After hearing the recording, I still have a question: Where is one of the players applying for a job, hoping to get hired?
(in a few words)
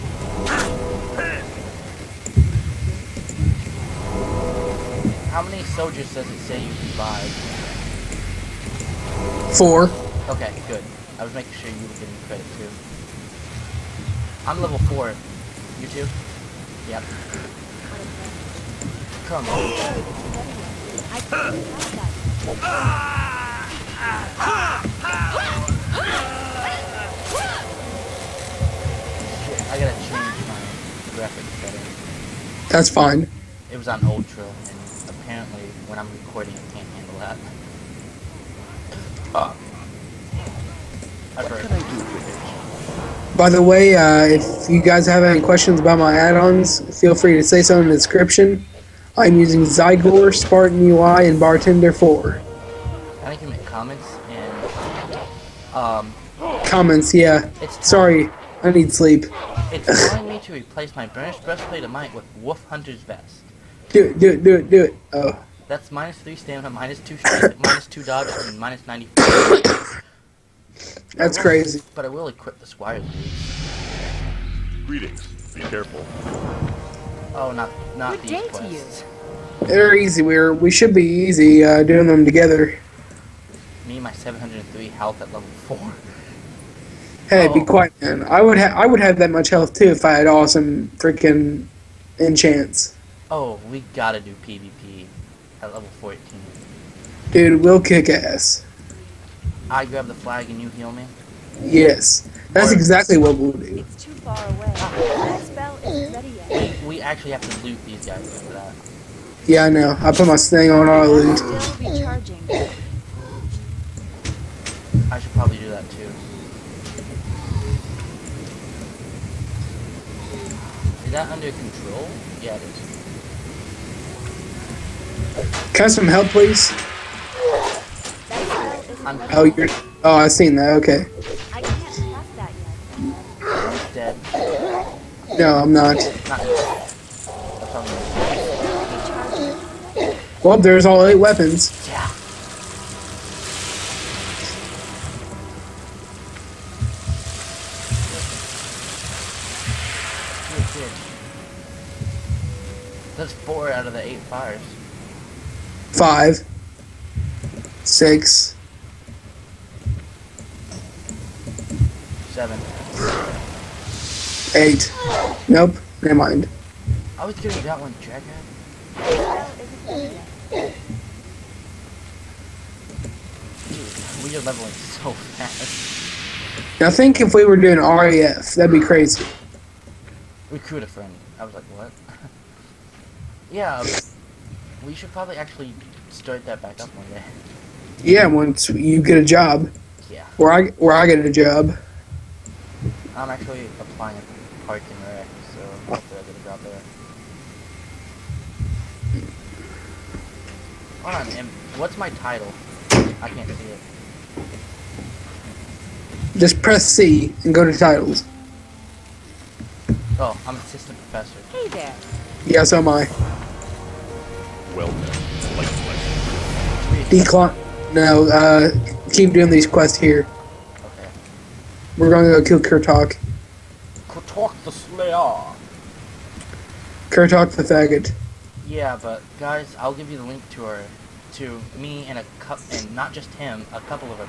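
Park and rec.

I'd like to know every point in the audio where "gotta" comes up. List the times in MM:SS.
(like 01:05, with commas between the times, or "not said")
00:21, 01:33.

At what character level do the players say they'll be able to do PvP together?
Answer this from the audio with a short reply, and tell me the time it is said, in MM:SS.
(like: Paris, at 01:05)
14, at 01:35.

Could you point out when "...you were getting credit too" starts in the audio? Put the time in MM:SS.
00:11.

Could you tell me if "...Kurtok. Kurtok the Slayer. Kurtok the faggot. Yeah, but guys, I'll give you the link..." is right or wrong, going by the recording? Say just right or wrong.
right.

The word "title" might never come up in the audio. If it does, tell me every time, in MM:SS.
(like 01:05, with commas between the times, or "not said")
03:22, 03:27.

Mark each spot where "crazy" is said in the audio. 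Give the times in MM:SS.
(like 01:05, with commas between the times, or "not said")
01:11, 02:58.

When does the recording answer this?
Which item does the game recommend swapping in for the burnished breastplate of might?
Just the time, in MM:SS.
01:02.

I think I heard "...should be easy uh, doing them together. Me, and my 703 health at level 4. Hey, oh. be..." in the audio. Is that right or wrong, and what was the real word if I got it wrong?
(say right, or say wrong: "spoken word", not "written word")
right.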